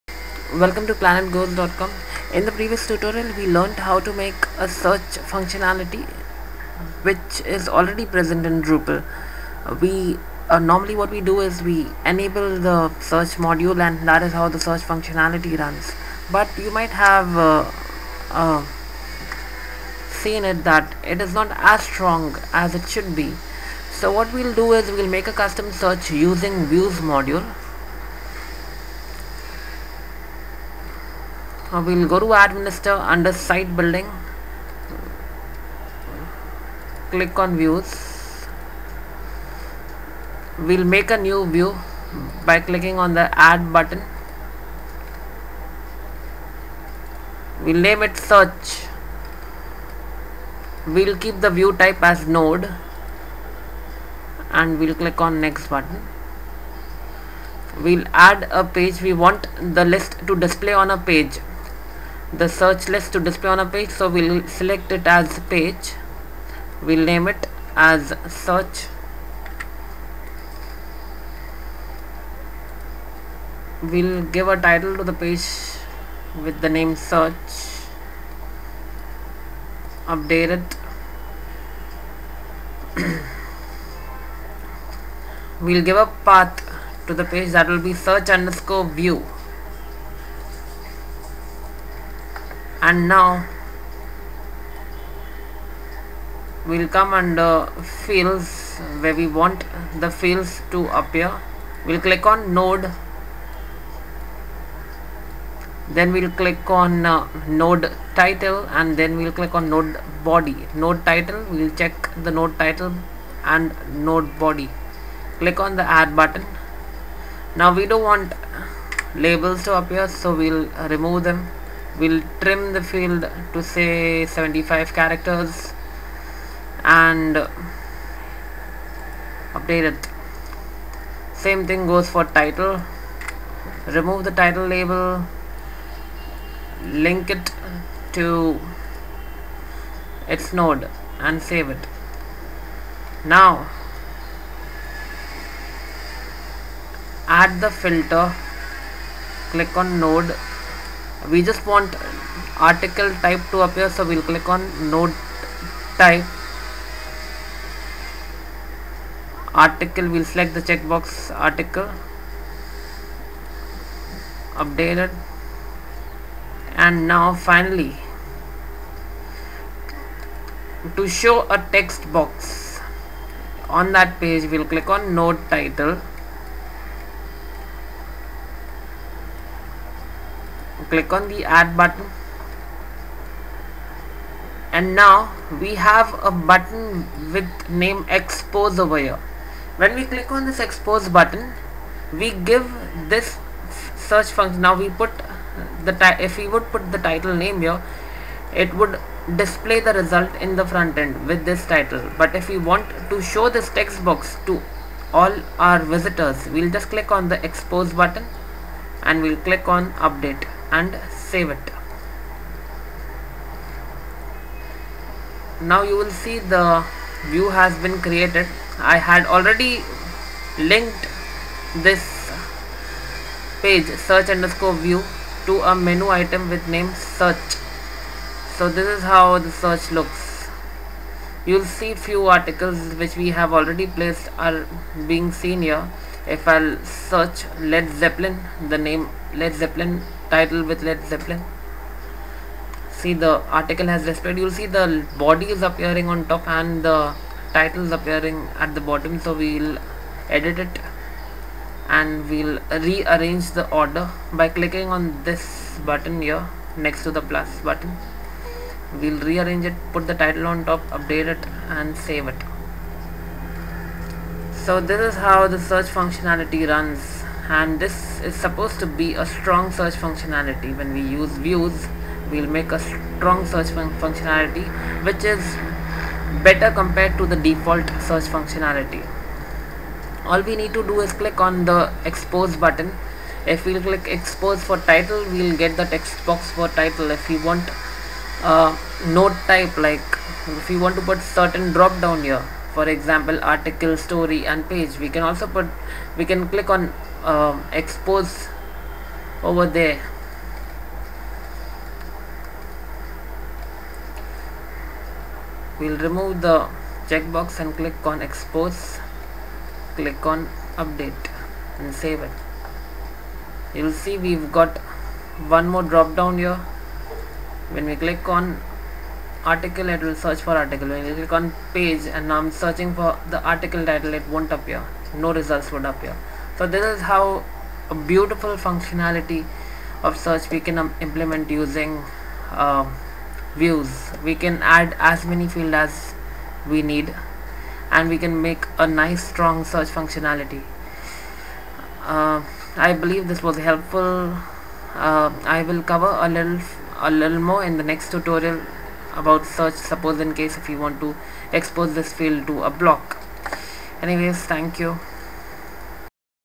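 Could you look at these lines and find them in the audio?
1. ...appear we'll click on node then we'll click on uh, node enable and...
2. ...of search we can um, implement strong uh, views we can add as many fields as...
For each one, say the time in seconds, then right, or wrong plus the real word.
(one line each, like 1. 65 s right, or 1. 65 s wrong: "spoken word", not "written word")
1. 100 s wrong: "title", not "enable"
2. 330 s wrong: "using", not "strong".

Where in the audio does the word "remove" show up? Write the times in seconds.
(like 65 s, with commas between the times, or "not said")
120 s, 133 s, 305 s.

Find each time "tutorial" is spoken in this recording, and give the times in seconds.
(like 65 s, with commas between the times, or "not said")
2 s, 348 s.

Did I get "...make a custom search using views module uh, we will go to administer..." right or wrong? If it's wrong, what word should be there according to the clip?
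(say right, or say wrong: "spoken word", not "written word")
right.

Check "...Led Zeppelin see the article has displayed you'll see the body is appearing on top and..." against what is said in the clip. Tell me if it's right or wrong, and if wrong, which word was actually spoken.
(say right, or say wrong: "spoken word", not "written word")
right.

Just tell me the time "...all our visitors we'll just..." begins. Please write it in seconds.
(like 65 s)
205 s.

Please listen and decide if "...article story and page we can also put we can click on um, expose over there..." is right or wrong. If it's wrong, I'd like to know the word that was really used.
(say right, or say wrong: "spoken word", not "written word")
right.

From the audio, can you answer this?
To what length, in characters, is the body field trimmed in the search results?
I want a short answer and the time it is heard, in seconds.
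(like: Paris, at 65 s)
75, at 124 s.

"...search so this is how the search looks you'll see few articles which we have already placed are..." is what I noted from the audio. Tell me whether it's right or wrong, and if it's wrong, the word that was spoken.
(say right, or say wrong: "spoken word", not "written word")
right.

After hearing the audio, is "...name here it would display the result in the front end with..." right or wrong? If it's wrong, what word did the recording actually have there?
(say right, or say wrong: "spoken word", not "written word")
right.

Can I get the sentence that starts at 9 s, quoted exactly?
Uh, we uh, normally what we do is we enable the search module and that is how the search functionality runs.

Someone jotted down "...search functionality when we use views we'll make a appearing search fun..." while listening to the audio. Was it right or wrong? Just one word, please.
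wrong.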